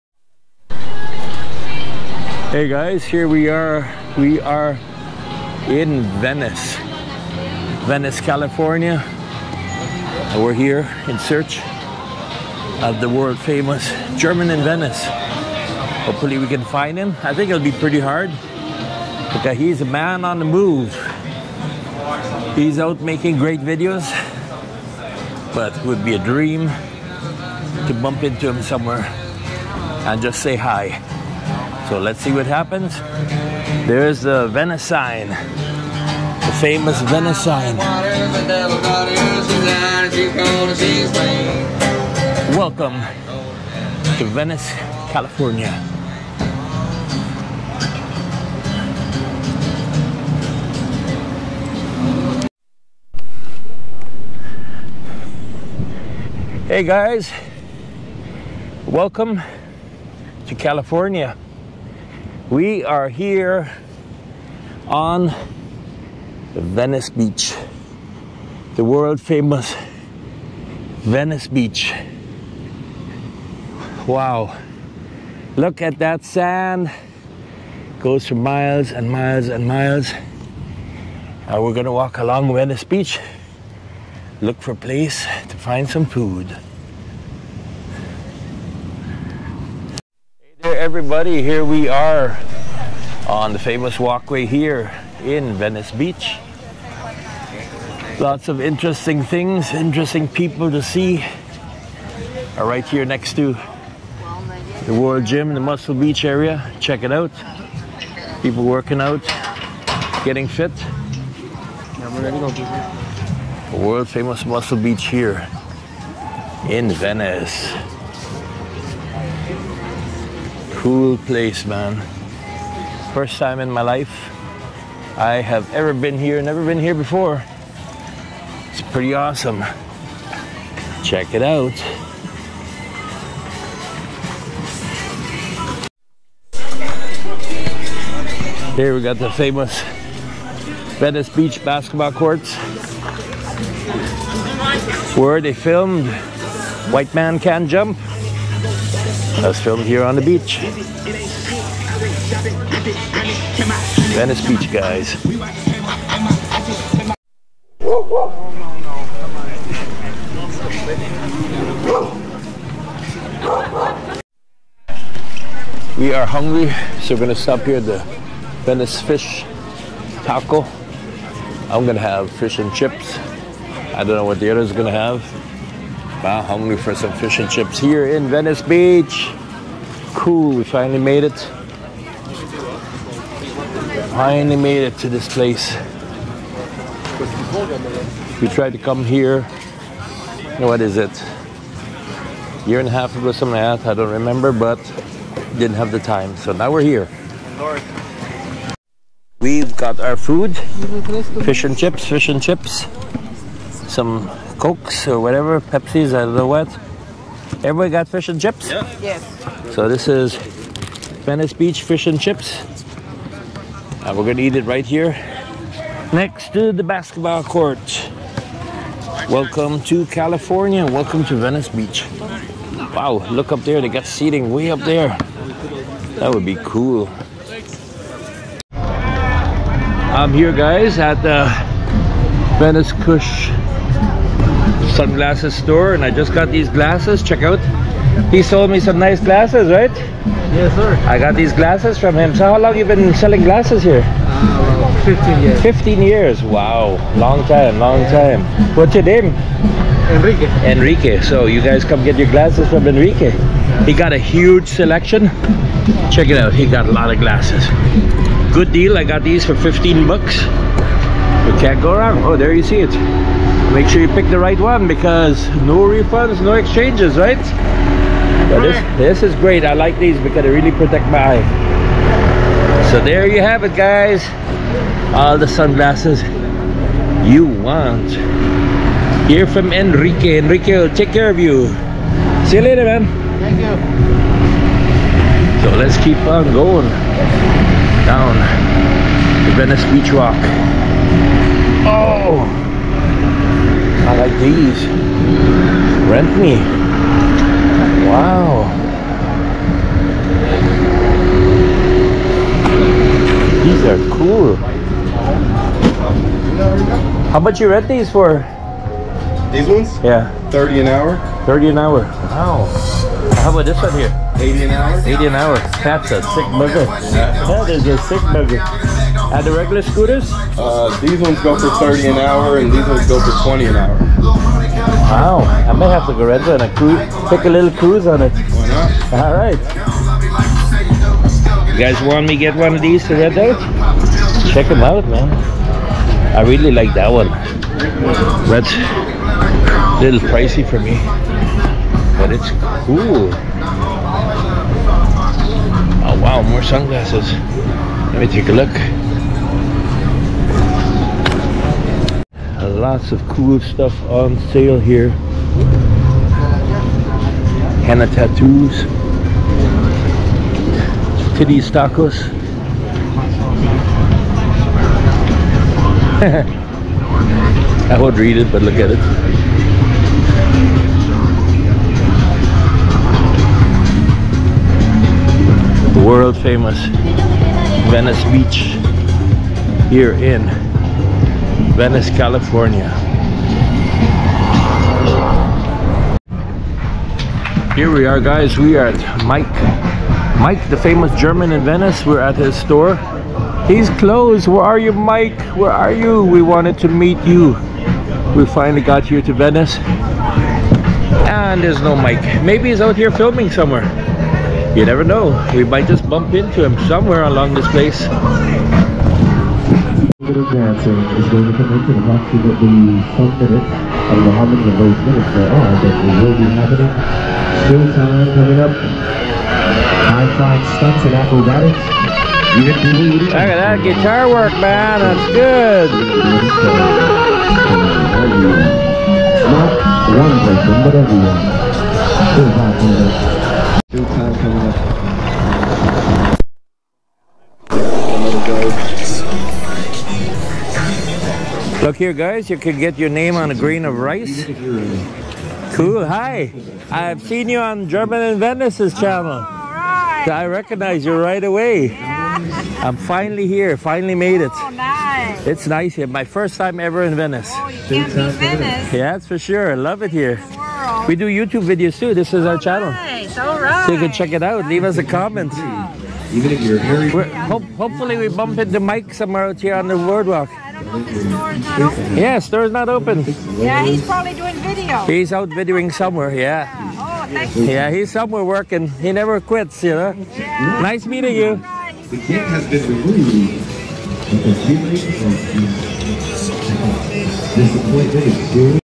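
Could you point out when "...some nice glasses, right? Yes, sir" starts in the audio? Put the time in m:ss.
3:58.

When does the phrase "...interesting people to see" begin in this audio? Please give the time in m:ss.
1:39.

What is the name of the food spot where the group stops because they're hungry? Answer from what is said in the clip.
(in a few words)
Venice Fish Taco.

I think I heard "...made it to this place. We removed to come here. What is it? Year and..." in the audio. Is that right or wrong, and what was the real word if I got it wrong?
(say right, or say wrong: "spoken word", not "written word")
wrong: "tried", not "removed".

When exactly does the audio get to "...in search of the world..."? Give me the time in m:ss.
0:11.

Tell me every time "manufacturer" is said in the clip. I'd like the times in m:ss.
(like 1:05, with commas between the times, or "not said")
not said.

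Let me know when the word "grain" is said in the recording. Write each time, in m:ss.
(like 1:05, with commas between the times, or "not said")
7:23.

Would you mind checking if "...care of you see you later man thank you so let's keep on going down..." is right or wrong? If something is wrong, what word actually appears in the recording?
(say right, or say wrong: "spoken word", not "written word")
right.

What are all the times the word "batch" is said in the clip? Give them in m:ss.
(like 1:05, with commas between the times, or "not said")
not said.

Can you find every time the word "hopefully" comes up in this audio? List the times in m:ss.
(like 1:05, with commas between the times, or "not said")
0:16, 7:47.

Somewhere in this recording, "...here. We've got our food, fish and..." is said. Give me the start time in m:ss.
3:16.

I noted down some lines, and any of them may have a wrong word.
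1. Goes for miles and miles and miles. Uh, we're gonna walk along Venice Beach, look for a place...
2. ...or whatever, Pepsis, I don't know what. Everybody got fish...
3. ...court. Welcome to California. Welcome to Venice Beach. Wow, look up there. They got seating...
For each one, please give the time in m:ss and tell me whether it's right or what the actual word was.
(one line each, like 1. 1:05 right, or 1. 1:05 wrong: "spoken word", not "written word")
1. 1:18 right
2. 3:25 right
3. 3:37 right.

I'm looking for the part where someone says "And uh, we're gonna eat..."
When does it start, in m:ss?
3:34.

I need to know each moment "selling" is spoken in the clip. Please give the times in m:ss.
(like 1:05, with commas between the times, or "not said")
4:03.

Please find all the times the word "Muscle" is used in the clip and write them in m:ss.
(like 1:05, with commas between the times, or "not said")
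1:45, 1:54.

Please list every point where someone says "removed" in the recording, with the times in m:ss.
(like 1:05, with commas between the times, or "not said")
8:08.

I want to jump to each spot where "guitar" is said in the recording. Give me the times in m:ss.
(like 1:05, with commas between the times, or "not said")
7:03.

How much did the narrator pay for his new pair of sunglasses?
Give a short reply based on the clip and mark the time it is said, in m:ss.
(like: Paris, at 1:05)
$15, at 4:19.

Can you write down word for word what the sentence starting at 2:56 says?
Wow, hungry for some fish and chips here in Venice Beach.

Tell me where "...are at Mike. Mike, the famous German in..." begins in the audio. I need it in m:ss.
6:28.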